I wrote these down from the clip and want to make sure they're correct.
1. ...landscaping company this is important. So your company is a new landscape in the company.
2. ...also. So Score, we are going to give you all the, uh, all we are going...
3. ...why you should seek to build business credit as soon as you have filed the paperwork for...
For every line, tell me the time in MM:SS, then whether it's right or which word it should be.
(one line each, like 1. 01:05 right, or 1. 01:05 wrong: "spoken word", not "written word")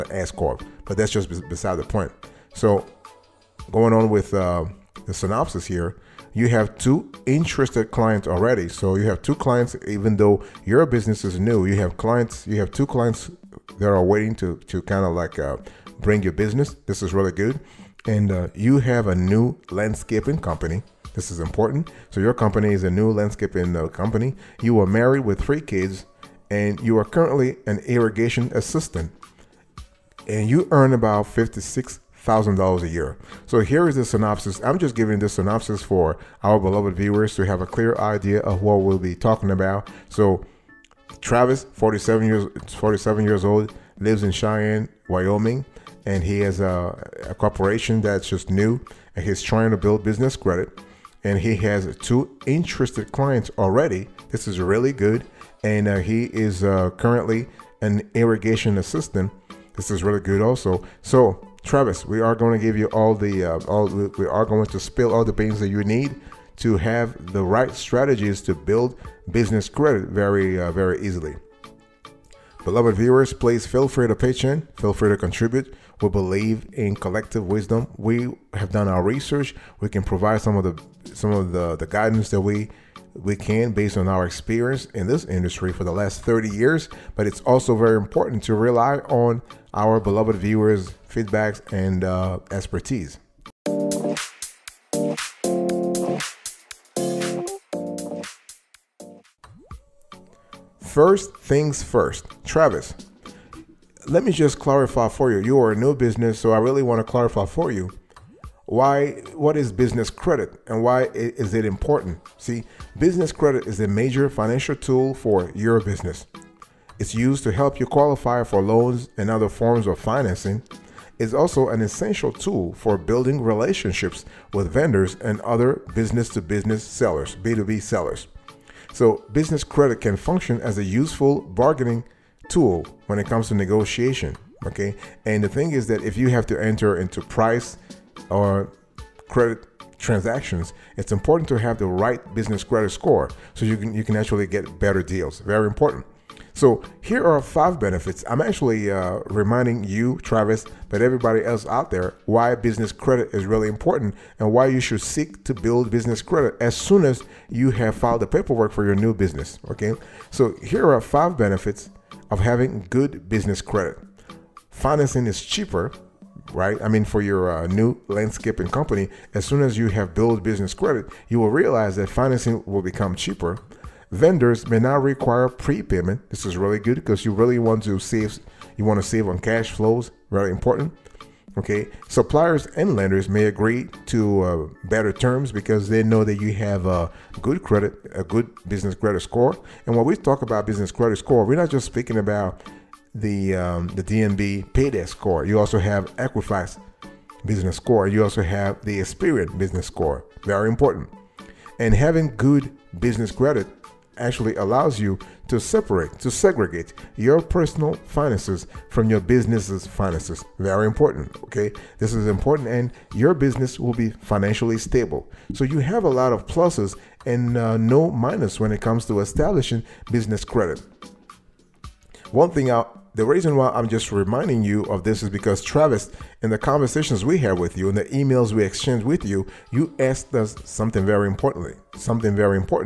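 1. 00:19 right
2. 01:00 wrong: "Travis", not "Score"
3. 02:34 right.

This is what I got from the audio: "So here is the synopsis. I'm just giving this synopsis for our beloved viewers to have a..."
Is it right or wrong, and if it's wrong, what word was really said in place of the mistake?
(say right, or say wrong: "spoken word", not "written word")
right.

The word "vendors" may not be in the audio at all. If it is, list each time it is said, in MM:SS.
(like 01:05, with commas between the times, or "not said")
02:04, 02:54.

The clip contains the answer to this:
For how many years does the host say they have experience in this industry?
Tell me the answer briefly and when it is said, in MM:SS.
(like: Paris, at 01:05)
30, at 01:26.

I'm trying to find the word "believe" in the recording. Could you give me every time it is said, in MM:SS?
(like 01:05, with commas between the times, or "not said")
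01:16.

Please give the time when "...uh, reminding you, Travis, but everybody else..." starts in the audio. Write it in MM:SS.
02:28.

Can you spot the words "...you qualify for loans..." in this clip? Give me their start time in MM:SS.
01:57.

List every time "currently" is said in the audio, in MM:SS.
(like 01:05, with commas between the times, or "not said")
00:27, 00:56.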